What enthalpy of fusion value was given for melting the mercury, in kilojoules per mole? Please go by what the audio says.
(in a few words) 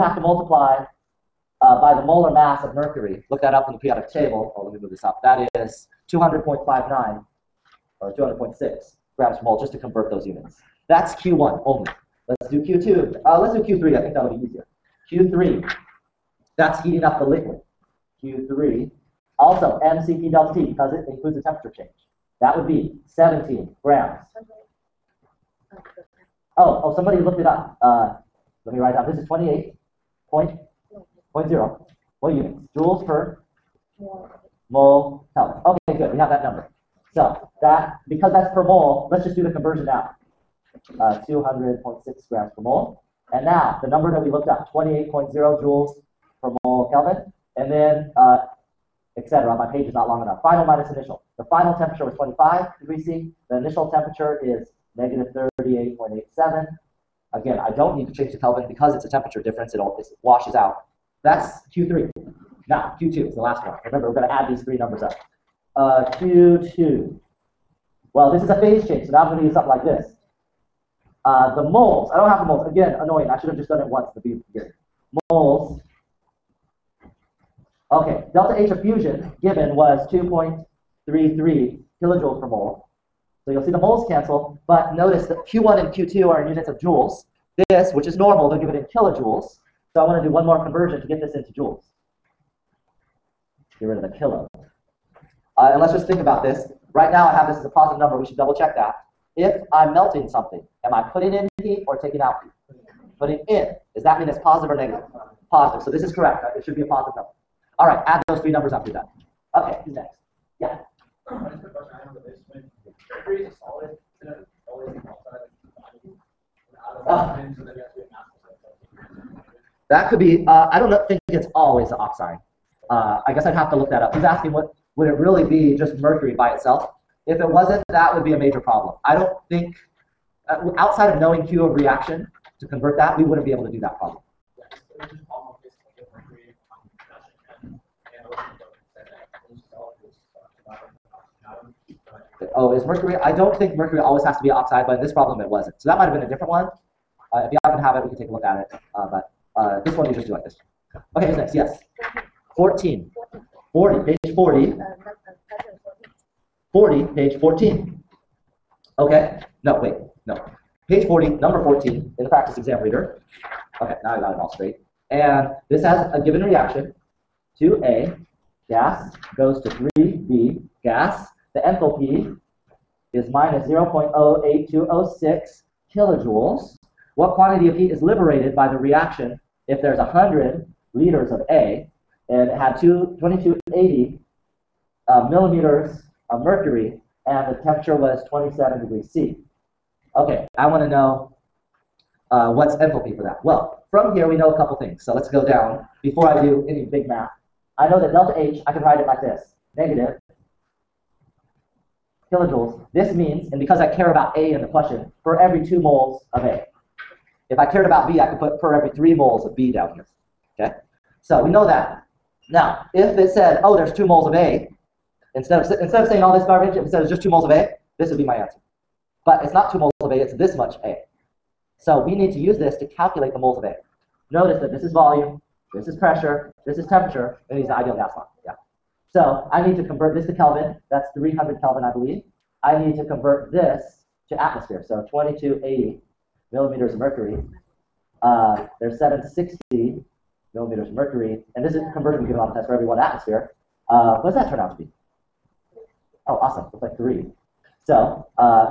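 2.33.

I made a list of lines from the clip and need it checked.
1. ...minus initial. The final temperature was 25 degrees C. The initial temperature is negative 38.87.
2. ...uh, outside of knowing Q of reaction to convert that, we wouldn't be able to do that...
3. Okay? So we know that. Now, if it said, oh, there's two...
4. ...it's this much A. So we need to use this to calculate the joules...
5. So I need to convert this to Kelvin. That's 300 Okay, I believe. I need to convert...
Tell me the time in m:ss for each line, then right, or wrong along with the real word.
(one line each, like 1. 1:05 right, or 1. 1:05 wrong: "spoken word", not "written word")
1. 0:50 right
2. 2:10 right
3. 3:30 right
4. 3:40 wrong: "moles", not "joules"
5. 3:49 wrong: "Kelvin", not "Okay".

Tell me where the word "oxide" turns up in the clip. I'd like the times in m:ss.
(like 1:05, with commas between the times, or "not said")
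2:01, 2:24.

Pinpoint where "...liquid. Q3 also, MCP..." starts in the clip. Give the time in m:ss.
0:17.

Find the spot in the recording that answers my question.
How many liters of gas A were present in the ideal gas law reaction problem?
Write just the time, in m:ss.
2:59.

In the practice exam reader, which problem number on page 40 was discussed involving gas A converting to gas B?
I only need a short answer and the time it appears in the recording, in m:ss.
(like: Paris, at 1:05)
14, at 2:41.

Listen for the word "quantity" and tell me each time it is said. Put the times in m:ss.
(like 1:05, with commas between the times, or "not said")
2:57.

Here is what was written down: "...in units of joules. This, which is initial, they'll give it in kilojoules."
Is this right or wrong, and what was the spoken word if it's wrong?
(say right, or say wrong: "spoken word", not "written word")
wrong: "normal", not "initial".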